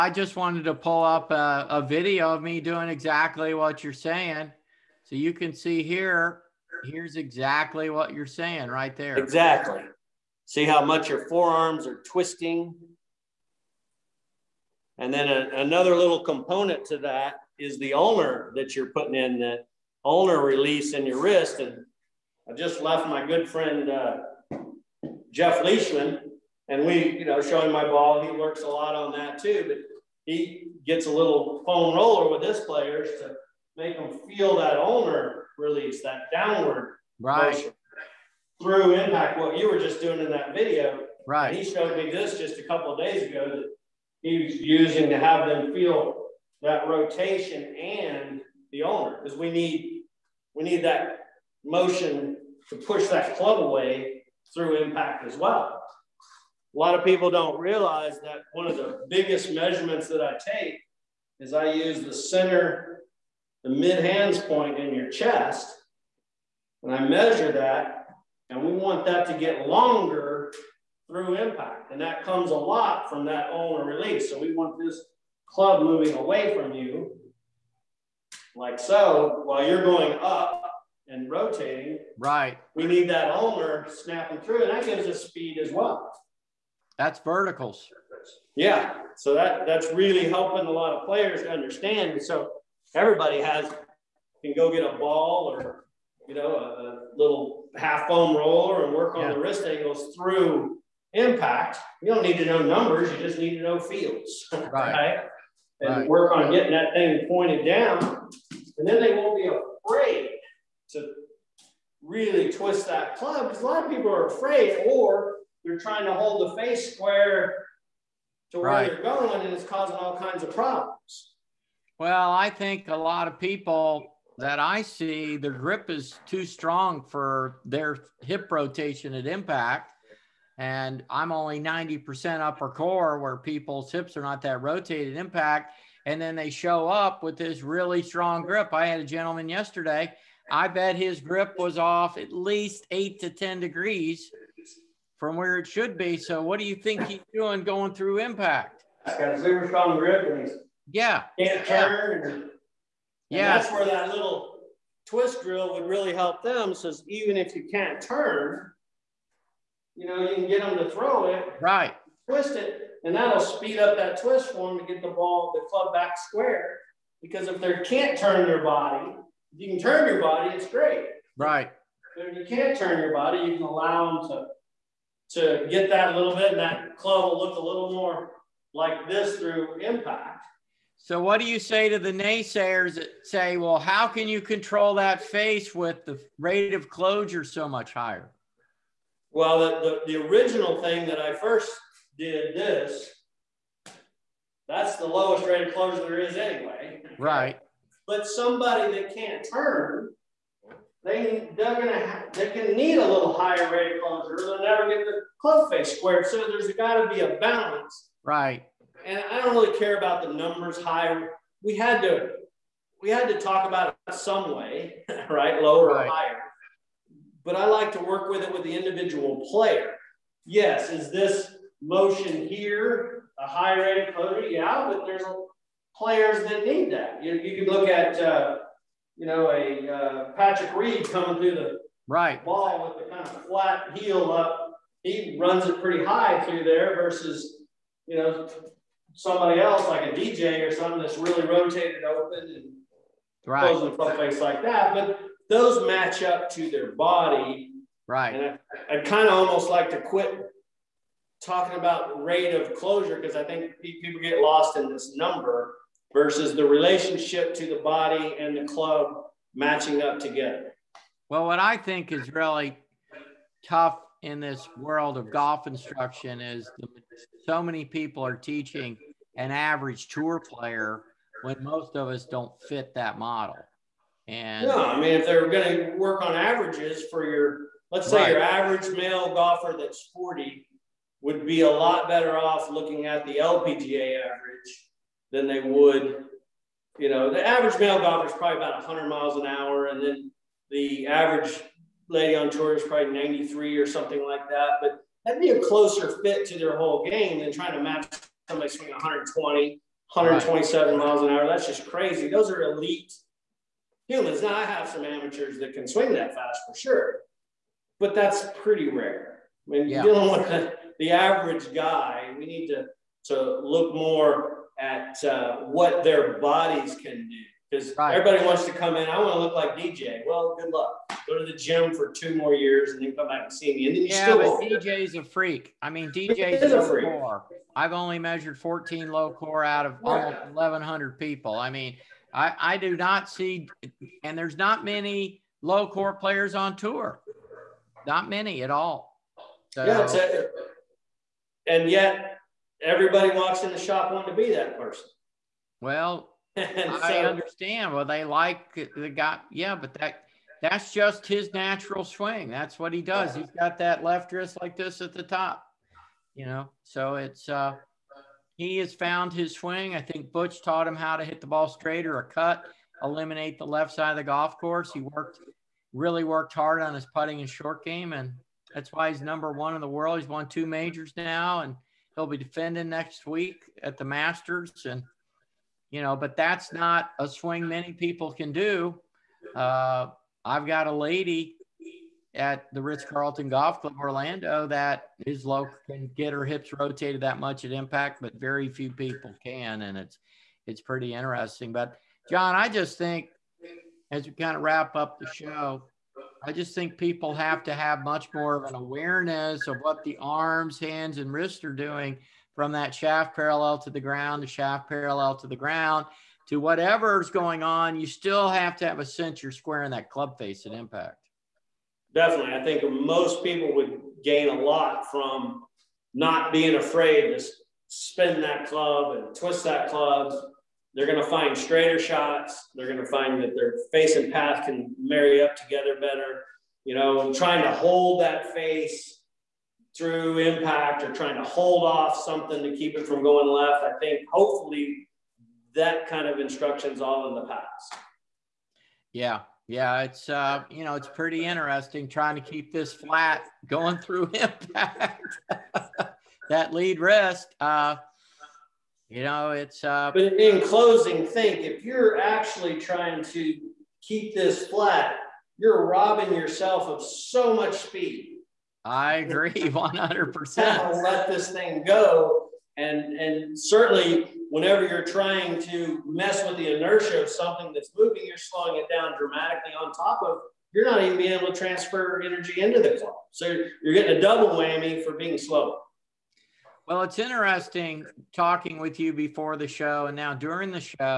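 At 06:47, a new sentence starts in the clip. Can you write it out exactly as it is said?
You still have to have a sense you're squaring that club face at impact definitely.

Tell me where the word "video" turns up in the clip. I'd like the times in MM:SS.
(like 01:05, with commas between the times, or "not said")
00:01, 00:40.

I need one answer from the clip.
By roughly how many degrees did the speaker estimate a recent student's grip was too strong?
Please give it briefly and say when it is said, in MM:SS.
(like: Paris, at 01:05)
8 to 10, at 02:22.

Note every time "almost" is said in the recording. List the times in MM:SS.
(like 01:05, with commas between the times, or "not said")
04:09, 05:30.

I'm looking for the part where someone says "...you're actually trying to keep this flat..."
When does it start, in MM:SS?
07:31.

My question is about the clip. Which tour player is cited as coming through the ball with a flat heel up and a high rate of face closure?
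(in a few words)
Patrick Reed.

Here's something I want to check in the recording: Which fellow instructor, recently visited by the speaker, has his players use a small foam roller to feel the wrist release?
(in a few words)
Jeff Leishman.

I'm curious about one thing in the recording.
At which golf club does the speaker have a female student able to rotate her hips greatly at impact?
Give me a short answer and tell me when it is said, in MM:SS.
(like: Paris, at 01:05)
Ritz Carlton Golf Club Orlando, at 06:22.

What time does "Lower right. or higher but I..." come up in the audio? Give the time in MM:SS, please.
03:35.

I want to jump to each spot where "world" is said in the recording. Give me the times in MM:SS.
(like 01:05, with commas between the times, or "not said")
04:24, 06:09.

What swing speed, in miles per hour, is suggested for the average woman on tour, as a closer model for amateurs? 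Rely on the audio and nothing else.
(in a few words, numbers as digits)
93.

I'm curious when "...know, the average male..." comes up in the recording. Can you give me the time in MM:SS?
04:47.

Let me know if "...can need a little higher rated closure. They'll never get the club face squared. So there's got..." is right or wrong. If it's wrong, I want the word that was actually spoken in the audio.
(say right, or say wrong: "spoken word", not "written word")
right.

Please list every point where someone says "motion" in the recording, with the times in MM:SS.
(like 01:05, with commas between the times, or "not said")
00:37, 00:51, 03:41.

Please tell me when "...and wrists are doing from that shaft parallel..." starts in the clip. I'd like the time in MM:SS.
06:41.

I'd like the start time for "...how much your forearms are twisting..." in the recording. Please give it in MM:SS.
00:10.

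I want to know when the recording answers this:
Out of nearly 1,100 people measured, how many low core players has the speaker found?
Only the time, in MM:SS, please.
05:28.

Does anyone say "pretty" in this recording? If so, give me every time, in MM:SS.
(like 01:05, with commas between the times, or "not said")
03:55, 05:08, 06:30, 07:21.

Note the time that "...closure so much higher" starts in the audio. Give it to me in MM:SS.
03:06.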